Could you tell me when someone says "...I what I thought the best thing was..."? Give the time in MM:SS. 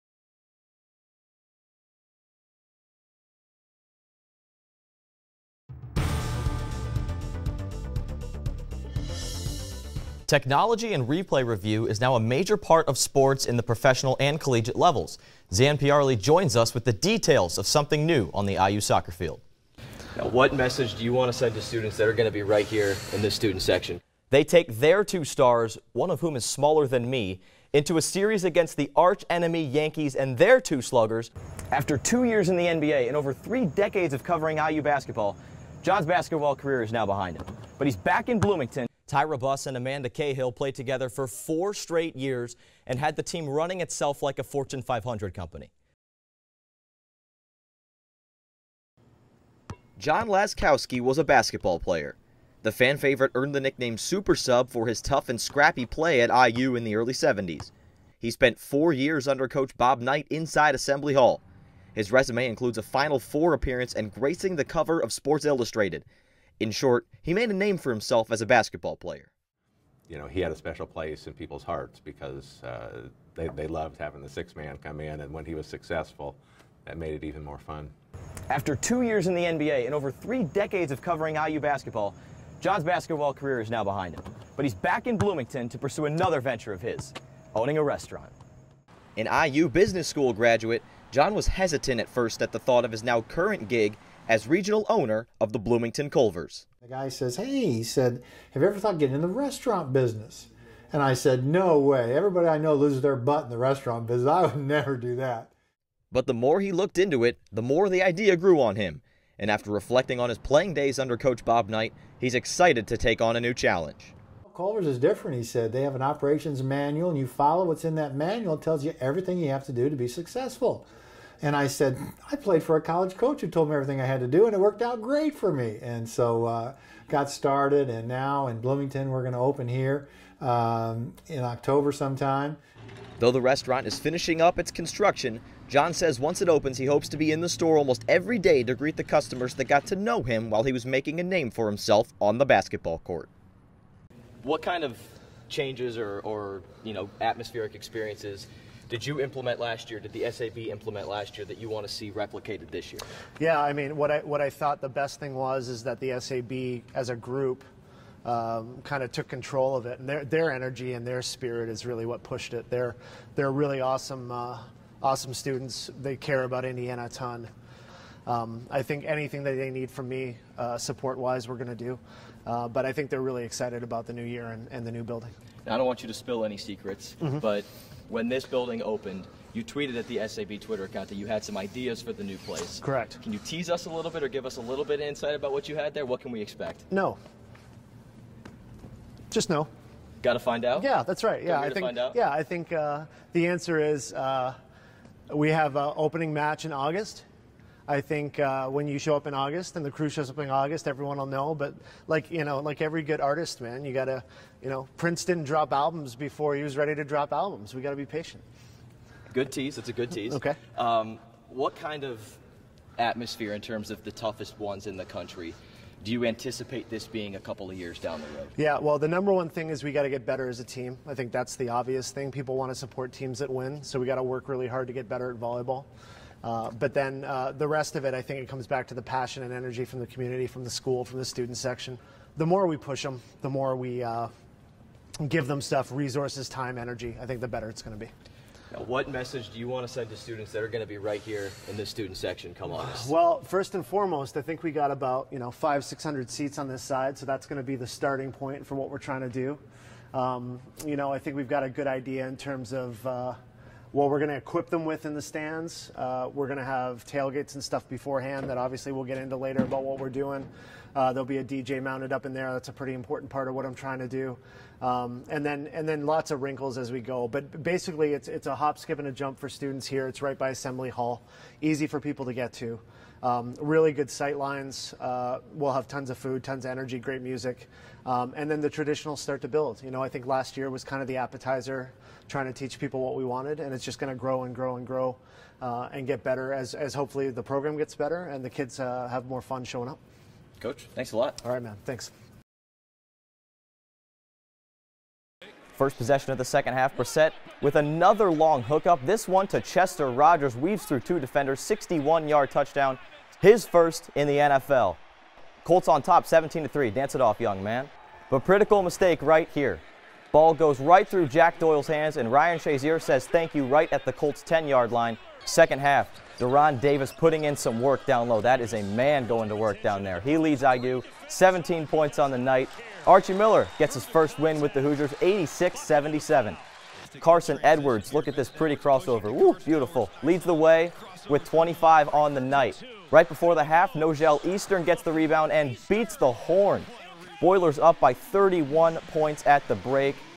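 02:34.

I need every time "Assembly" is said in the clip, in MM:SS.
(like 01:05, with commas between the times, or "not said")
01:00, 04:30.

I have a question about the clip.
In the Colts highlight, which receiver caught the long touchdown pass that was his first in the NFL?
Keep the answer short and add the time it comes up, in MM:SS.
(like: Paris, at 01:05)
Chester Rogers, at 04:59.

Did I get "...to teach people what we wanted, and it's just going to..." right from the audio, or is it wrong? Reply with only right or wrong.
right.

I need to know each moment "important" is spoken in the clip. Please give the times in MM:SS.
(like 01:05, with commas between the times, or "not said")
04:22.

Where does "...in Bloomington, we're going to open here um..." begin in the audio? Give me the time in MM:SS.
02:08.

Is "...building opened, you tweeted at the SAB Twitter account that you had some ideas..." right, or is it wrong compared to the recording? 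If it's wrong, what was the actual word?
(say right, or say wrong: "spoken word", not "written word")
right.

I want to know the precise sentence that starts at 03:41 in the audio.
I think that's the obvious thing.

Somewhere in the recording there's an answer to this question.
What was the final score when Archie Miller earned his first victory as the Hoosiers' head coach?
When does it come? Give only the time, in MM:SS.
05:25.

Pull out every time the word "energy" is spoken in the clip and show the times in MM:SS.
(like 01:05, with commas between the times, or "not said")
02:40, 03:49, 03:56, 04:36.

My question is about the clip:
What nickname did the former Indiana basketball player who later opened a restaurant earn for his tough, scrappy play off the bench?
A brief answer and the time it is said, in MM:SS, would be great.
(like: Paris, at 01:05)
Super Sub, at 00:53.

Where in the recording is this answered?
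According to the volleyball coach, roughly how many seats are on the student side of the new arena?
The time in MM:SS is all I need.
04:05.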